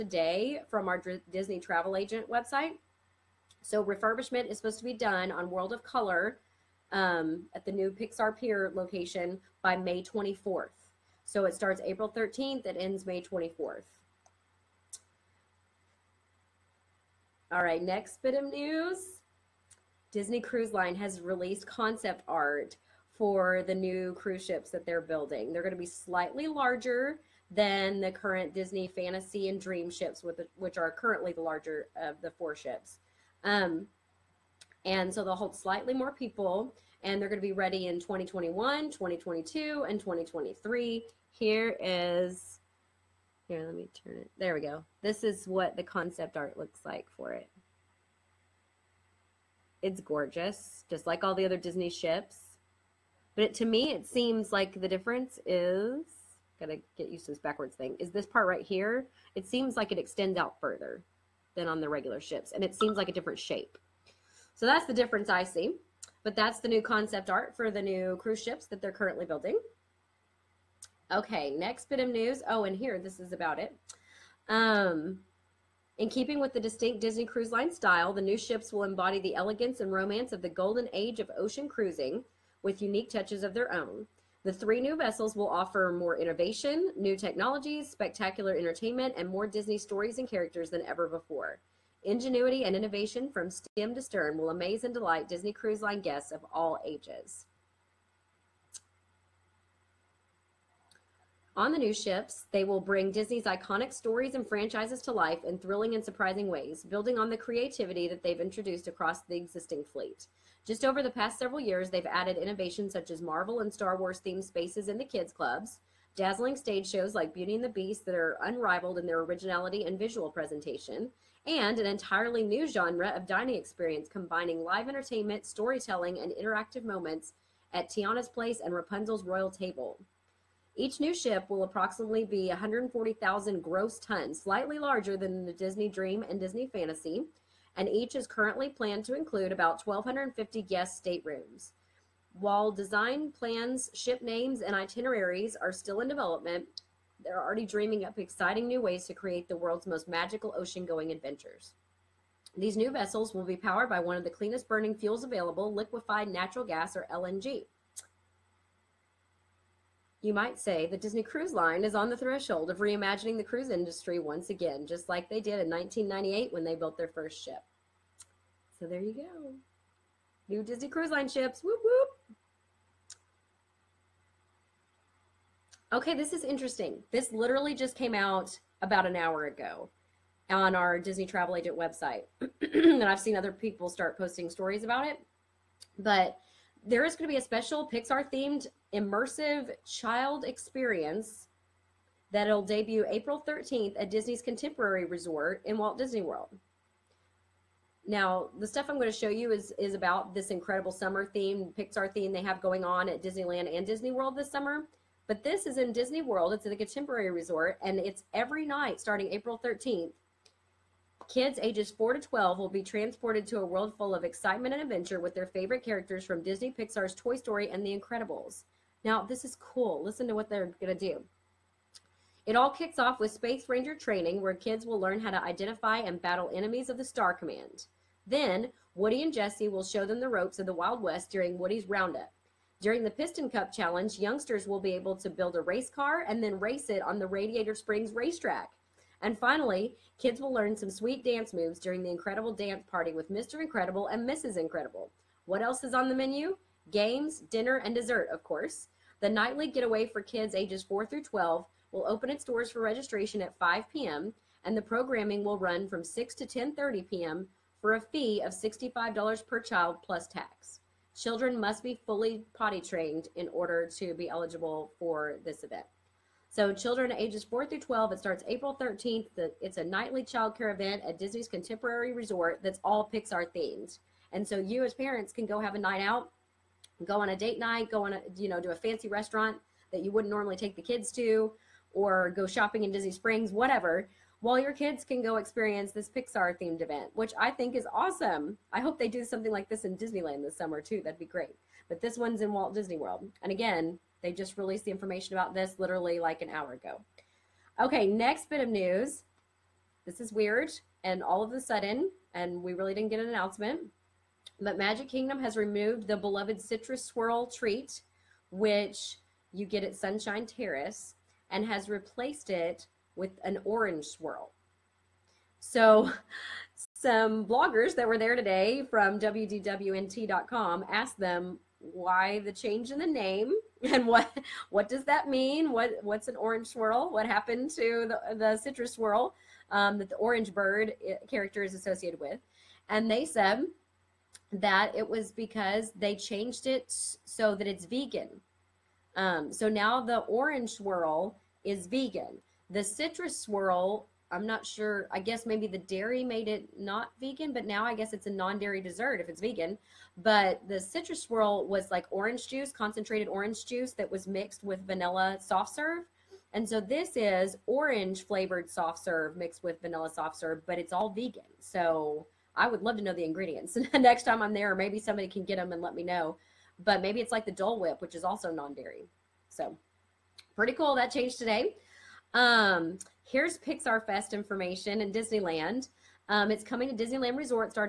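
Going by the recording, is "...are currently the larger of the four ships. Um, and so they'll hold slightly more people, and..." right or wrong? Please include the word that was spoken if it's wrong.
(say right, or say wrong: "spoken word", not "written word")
right.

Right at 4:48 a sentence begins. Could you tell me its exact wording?
I hope they do something like this in Disneyland this summer too.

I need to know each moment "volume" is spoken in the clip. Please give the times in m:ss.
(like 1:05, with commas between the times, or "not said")
not said.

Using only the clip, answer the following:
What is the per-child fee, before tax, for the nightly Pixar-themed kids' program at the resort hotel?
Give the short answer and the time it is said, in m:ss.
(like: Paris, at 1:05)
$65, at 4:18.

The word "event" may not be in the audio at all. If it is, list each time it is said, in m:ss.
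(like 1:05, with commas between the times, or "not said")
4:25, 4:30, 4:46.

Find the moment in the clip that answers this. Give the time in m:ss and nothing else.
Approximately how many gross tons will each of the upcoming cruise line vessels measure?
2:12.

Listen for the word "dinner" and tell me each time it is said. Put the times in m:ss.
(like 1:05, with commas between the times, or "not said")
4:07.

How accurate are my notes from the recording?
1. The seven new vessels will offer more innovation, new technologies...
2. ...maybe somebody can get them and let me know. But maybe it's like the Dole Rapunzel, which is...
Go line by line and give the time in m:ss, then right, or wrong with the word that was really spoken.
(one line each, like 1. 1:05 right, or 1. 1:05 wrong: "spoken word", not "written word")
1. 1:24 wrong: "three", not "seven"
2. 6:04 wrong: "Whip", not "Rapunzel".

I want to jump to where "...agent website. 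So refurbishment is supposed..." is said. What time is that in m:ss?
0:01.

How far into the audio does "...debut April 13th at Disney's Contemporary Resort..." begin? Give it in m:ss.
3:12.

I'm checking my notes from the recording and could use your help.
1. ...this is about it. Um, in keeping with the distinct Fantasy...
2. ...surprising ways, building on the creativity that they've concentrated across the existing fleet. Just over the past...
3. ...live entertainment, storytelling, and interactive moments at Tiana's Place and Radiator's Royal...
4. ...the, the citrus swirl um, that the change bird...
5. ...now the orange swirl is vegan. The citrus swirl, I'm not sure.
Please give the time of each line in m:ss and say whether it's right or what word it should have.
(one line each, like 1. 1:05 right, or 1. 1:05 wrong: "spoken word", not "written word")
1. 1:12 wrong: "Disney", not "Fantasy"
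2. 1:46 wrong: "introduced", not "concentrated"
3. 2:04 wrong: "Rapunzel", not "Radiator"
4. 5:28 wrong: "orange", not "change"
5. 5:39 right.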